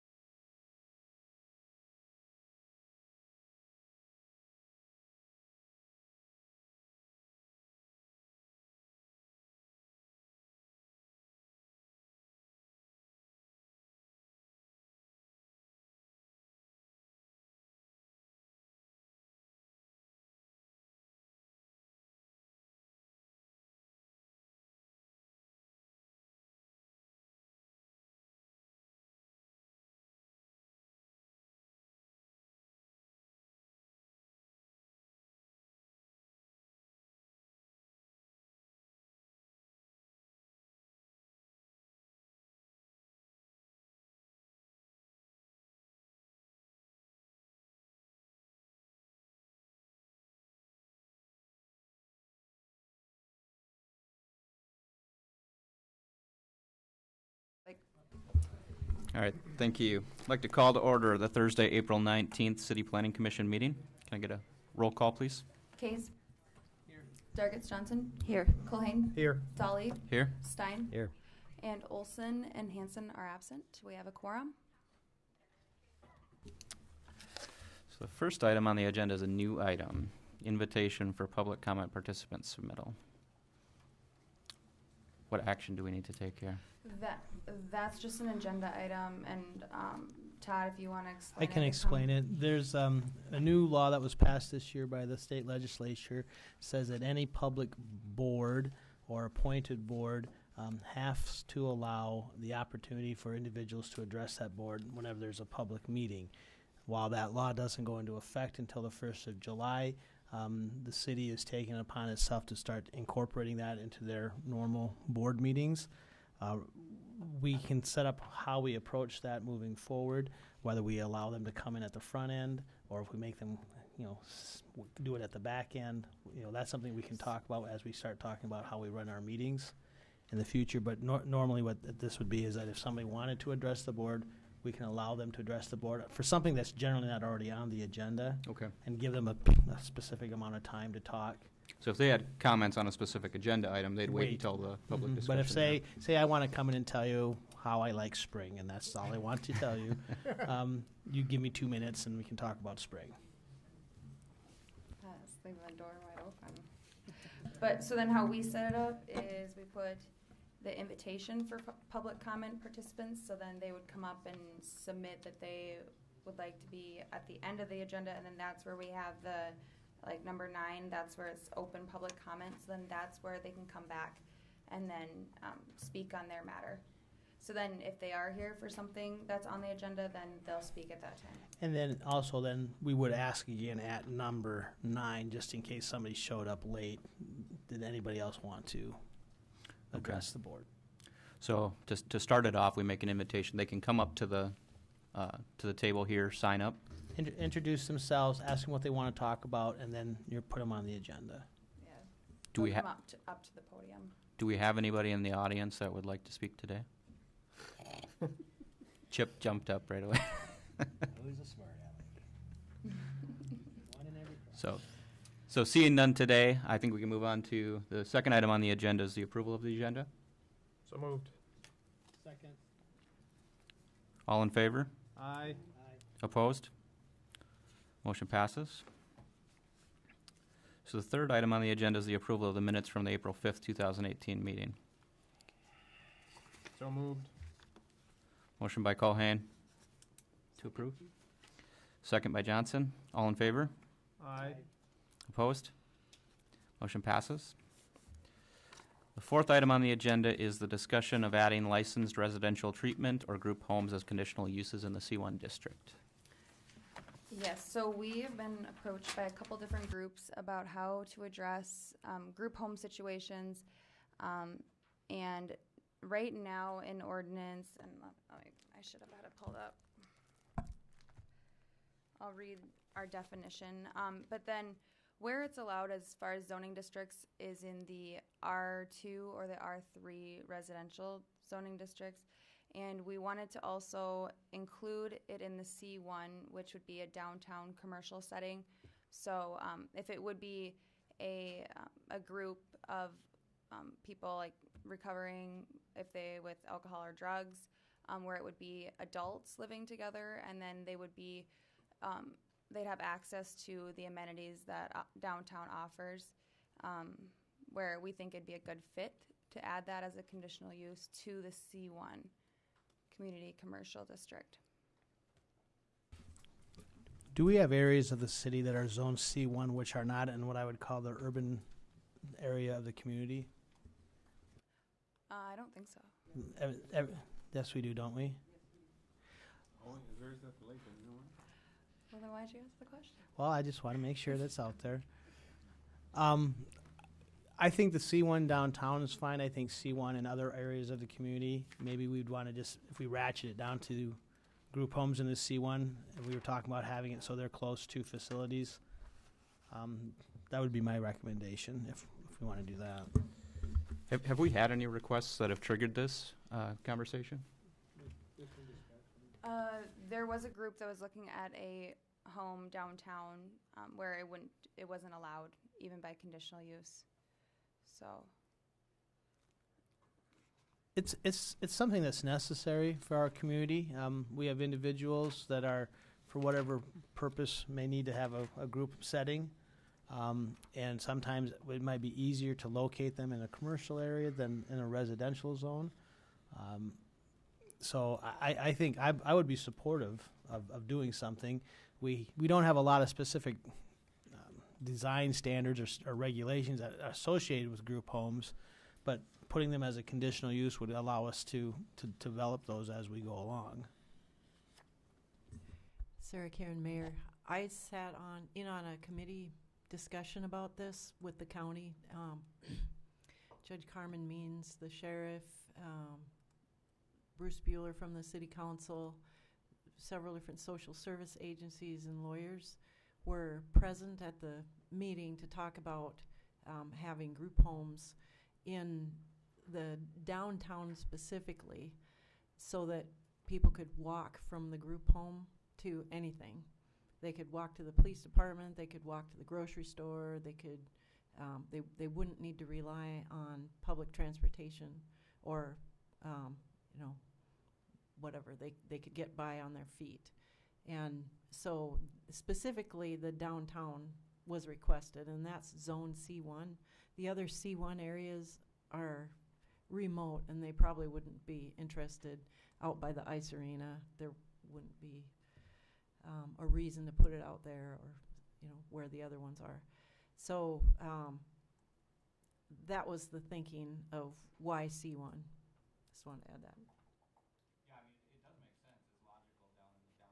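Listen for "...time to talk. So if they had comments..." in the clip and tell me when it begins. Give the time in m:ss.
2:20.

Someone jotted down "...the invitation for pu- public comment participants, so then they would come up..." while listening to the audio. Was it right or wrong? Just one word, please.
right.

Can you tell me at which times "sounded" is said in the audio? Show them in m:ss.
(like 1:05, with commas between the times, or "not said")
not said.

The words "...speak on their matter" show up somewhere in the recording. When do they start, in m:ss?
2:55.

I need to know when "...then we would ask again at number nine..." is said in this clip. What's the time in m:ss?
3:02.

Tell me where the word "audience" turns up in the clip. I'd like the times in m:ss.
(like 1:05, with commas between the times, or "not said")
3:25.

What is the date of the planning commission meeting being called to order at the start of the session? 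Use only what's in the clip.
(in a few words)
Thursday, April 19th.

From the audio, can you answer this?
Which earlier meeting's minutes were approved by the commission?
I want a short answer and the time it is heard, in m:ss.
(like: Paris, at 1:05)
April 5th, 2018, at 3:53.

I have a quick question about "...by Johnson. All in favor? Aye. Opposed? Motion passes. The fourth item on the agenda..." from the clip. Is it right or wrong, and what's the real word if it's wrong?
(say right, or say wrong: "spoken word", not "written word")
right.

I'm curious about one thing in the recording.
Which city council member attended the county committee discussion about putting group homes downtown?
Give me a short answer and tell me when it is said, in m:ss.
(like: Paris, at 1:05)
Bruce Bueller, at 6:57.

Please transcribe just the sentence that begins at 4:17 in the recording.
Yes, so we've been approached by a couple different groups about how to address um, group home situations.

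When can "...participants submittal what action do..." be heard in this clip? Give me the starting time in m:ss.
1:21.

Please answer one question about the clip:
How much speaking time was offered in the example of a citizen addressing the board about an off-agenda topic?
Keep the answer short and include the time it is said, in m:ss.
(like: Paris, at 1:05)
two minutes, at 2:31.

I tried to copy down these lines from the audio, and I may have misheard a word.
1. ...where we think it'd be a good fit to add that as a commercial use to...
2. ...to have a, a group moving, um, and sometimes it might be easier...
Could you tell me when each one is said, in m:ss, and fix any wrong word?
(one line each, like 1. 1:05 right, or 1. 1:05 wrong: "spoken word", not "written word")
1. 5:07 wrong: "conditional", not "commercial"
2. 6:18 wrong: "setting", not "moving".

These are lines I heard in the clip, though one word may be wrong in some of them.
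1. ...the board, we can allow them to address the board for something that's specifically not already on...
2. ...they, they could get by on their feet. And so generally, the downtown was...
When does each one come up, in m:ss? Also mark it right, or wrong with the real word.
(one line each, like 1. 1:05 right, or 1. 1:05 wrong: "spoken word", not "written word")
1. 2:13 wrong: "generally", not "specifically"
2. 7:28 wrong: "specifically", not "generally".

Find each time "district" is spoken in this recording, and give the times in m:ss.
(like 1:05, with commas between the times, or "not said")
4:15, 4:36, 4:41, 5:14.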